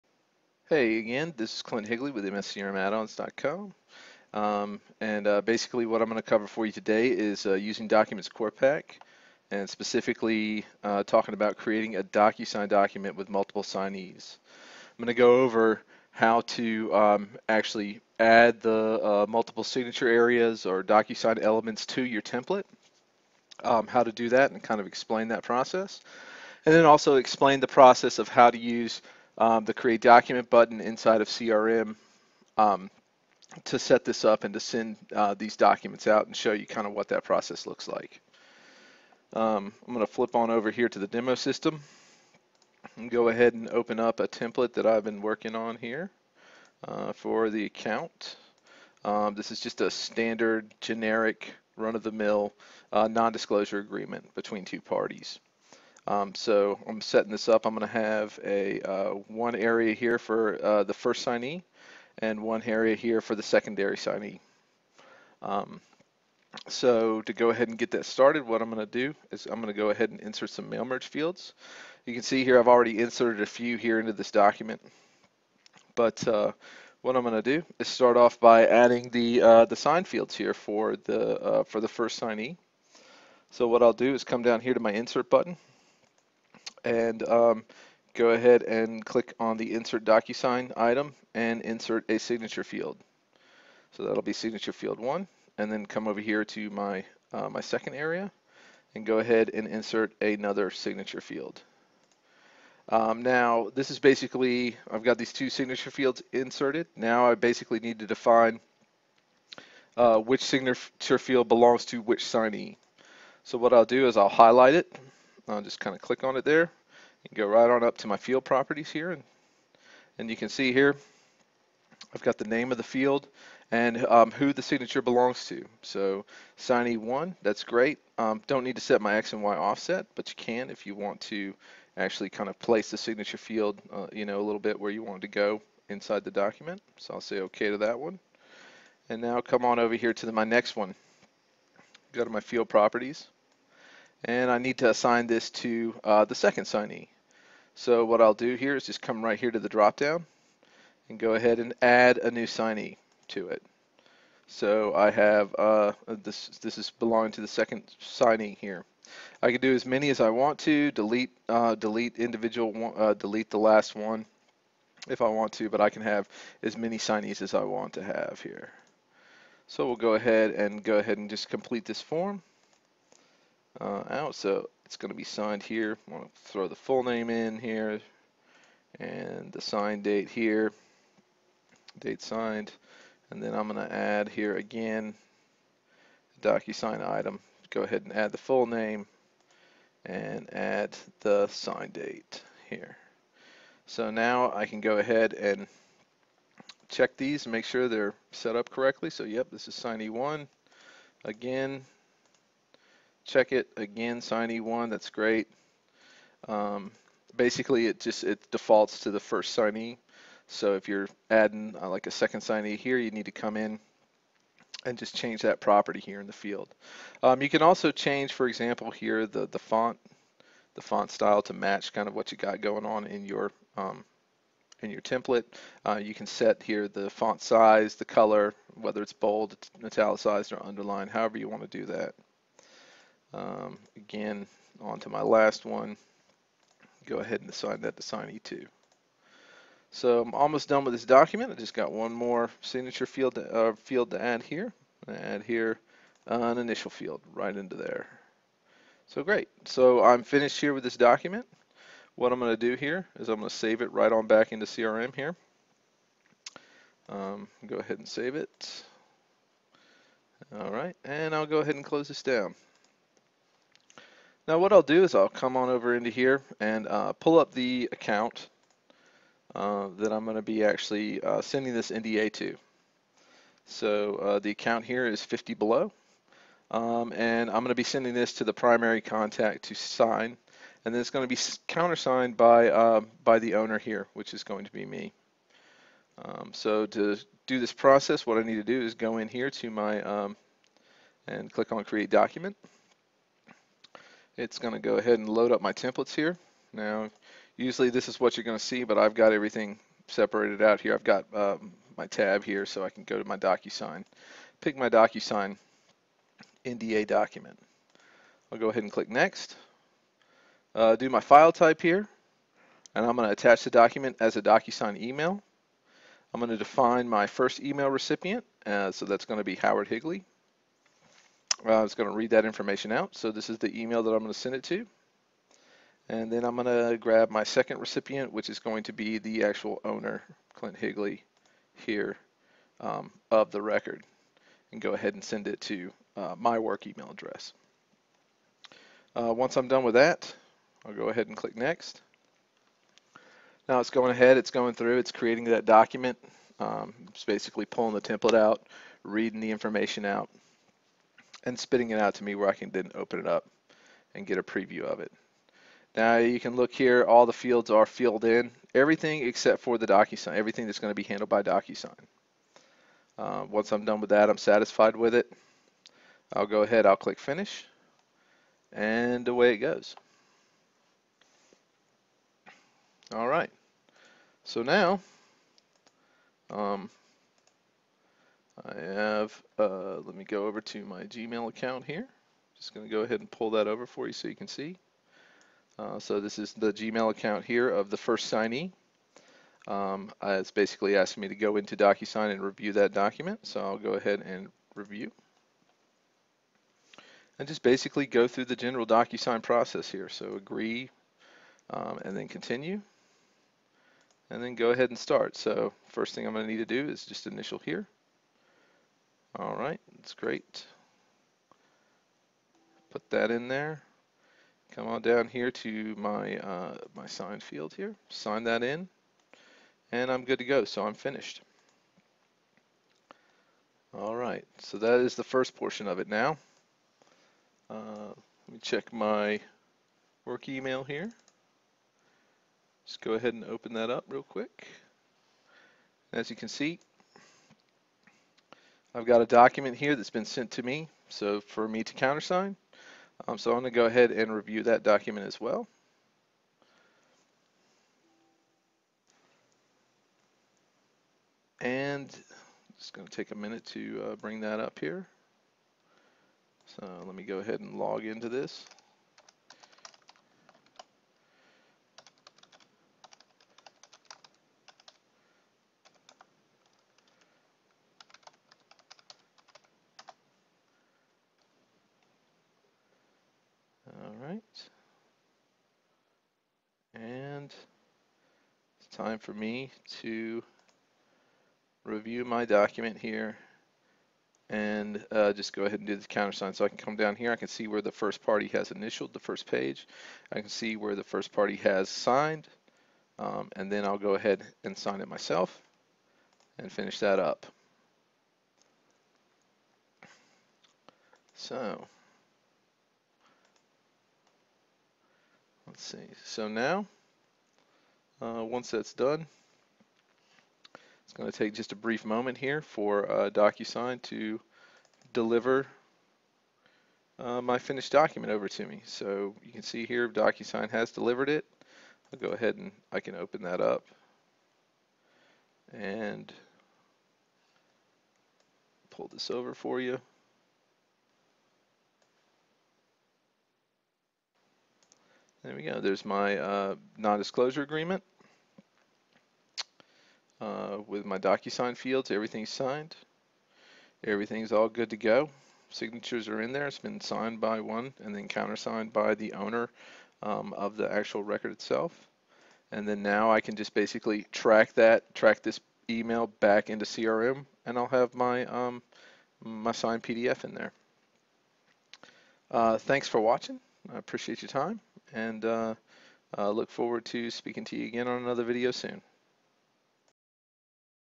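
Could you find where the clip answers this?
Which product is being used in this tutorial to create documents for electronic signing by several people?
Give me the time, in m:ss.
0:07.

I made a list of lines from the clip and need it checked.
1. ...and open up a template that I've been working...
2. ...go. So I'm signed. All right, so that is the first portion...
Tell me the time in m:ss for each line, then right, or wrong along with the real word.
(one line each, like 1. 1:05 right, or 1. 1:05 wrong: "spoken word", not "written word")
1. 0:43 right
2. 7:00 wrong: "finished", not "signed".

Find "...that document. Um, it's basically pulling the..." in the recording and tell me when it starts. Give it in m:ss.
5:45.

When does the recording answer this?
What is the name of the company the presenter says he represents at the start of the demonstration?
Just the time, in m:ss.
0:02.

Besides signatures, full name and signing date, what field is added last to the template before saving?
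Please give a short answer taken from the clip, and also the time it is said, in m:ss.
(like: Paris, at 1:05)
Initial field, at 4:06.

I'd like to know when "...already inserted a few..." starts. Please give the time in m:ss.
1:12.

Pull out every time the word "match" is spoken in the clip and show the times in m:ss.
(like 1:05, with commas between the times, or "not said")
3:41.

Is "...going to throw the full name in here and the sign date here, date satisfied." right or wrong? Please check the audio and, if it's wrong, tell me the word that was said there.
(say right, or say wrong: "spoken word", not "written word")
wrong: "signed", not "satisfied".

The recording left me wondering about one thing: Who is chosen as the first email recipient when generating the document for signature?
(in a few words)
Howard Higley.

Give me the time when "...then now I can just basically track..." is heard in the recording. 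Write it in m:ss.
9:12.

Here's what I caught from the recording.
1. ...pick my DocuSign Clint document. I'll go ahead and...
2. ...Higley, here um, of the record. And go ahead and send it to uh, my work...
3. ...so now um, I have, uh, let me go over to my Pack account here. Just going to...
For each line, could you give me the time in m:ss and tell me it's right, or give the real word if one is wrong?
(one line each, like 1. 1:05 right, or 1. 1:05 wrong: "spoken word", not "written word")
1. 5:04 wrong: "NDA", not "Clint"
2. 5:30 right
3. 6:14 wrong: "Gmail", not "Pack".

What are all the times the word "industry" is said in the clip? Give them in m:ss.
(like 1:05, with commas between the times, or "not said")
not said.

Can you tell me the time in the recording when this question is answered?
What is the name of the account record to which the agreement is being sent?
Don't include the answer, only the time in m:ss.
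4:35.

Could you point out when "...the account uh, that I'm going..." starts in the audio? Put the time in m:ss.
4:27.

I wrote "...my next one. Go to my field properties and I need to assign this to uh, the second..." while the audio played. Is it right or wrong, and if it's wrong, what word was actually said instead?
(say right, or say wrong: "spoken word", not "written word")
right.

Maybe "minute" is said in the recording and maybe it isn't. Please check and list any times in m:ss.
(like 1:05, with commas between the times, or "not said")
7:33.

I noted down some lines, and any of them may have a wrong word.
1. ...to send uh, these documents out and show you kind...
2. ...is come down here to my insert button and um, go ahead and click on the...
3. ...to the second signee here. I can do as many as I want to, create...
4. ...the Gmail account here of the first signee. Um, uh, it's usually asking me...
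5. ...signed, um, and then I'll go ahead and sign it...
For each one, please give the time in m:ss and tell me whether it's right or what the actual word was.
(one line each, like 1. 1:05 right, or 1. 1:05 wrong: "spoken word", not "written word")
1. 0:34 right
2. 1:24 right
3. 2:37 wrong: "delete", not "create"
4. 6:26 wrong: "basically", not "usually"
5. 8:11 right.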